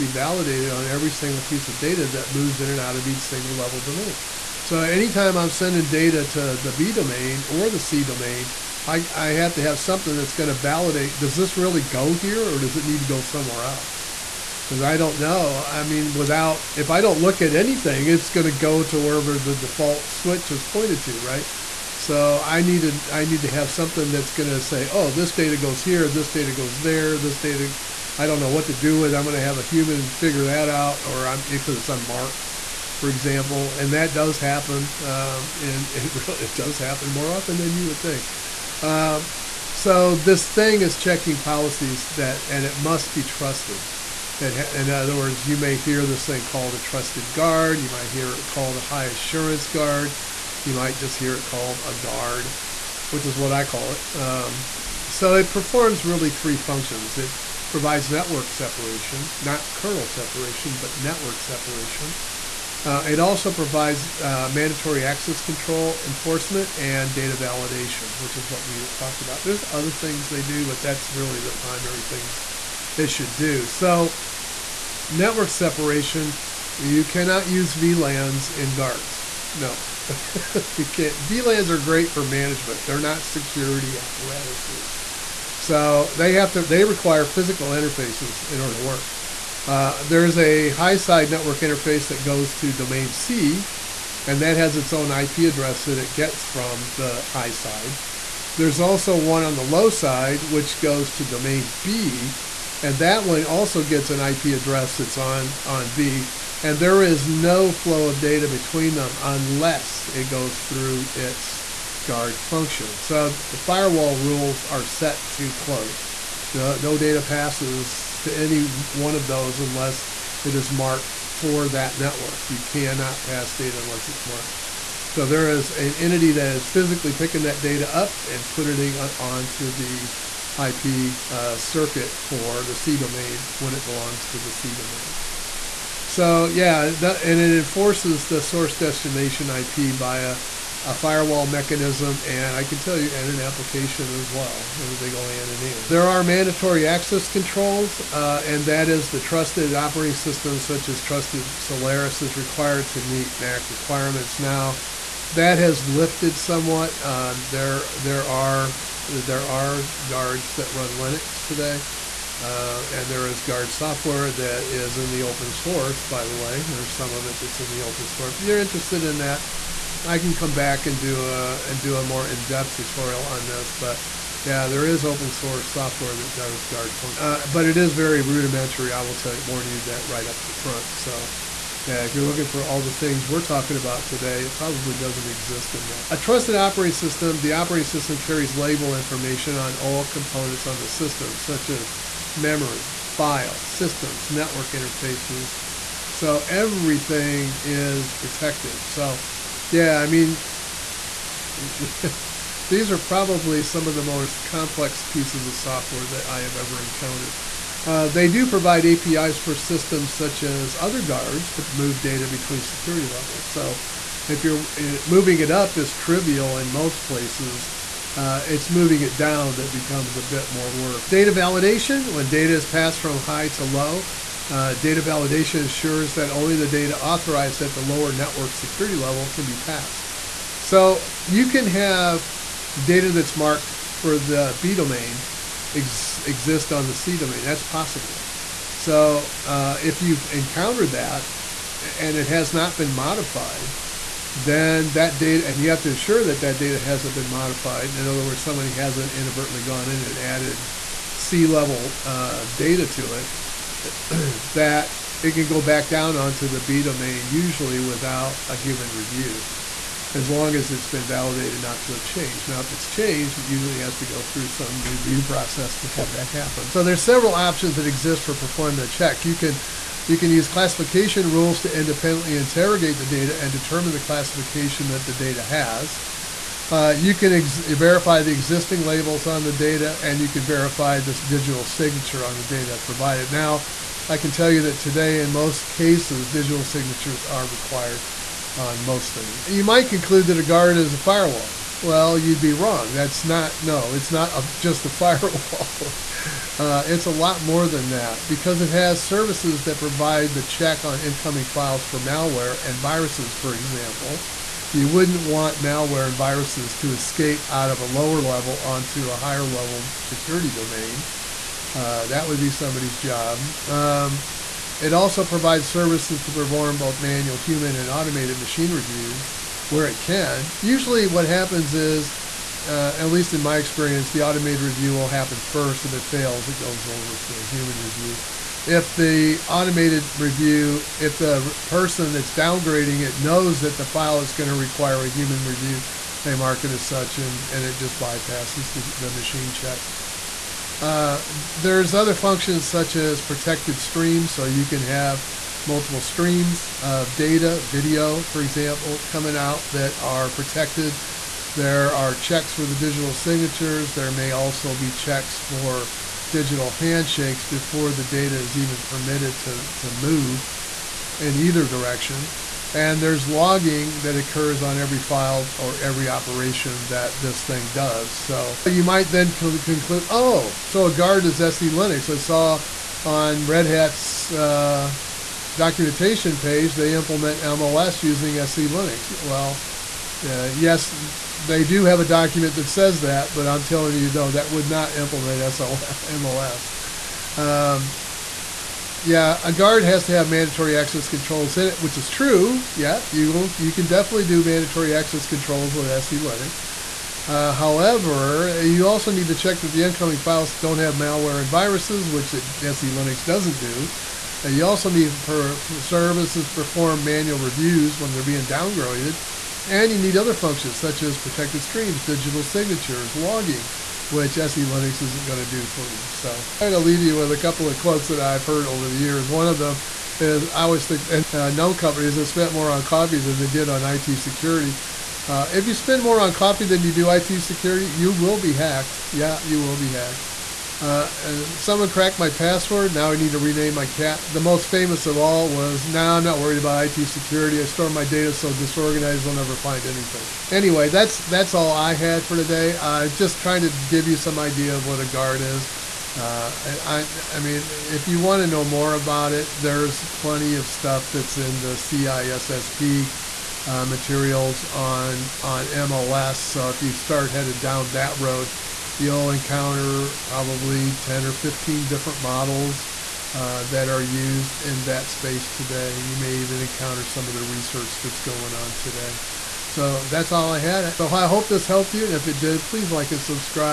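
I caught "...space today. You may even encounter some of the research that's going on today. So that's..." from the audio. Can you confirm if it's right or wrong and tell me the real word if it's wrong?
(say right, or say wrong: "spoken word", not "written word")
right.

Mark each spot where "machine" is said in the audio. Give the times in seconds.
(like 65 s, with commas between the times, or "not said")
318 s, 339 s.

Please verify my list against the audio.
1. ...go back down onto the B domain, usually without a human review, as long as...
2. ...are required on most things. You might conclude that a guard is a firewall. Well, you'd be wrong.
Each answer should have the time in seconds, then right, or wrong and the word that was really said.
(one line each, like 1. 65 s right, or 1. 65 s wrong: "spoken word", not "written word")
1. 255 s right
2. 287 s right.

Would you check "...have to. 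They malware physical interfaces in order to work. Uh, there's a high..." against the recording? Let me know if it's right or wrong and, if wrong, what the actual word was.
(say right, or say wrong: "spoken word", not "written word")
wrong: "require", not "malware".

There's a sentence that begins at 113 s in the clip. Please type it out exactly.
So the firewall rules are set to closed.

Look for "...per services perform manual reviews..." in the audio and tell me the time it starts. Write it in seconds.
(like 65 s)
405 s.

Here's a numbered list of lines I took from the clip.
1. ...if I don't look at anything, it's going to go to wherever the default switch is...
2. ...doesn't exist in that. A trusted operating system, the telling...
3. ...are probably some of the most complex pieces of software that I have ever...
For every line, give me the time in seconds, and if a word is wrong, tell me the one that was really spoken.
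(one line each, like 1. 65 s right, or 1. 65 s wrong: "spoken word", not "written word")
1. 16 s right
2. 184 s wrong: "operating", not "telling"
3. 202 s right.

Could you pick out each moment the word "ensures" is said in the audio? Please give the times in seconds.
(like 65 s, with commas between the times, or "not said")
225 s, 245 s.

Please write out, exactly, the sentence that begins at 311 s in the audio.
Uh, that would be somebody's job.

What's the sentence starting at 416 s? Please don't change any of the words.
So I'm going to leave you with a couple of quotes that I've heard over the years.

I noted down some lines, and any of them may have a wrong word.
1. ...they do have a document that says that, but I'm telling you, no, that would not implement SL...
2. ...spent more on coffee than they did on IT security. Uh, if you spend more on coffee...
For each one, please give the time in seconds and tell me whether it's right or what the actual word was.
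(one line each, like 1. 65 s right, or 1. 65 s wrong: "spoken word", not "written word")
1. 381 s right
2. 422 s right.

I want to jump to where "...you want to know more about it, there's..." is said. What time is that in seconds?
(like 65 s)
448 s.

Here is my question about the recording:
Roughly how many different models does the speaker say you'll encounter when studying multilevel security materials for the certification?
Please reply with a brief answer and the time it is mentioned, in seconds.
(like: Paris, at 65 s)
10 or 15, at 460 s.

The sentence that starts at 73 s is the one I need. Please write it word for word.
So, network separation, you cannot use VLANs in guards.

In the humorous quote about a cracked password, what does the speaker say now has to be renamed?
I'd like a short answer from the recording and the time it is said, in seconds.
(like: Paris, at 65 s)
my cat, at 433 s.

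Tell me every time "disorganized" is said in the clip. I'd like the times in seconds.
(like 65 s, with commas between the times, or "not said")
438 s.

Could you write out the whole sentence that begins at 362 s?
And there's logging that occurs on every file or every operation that this thing does.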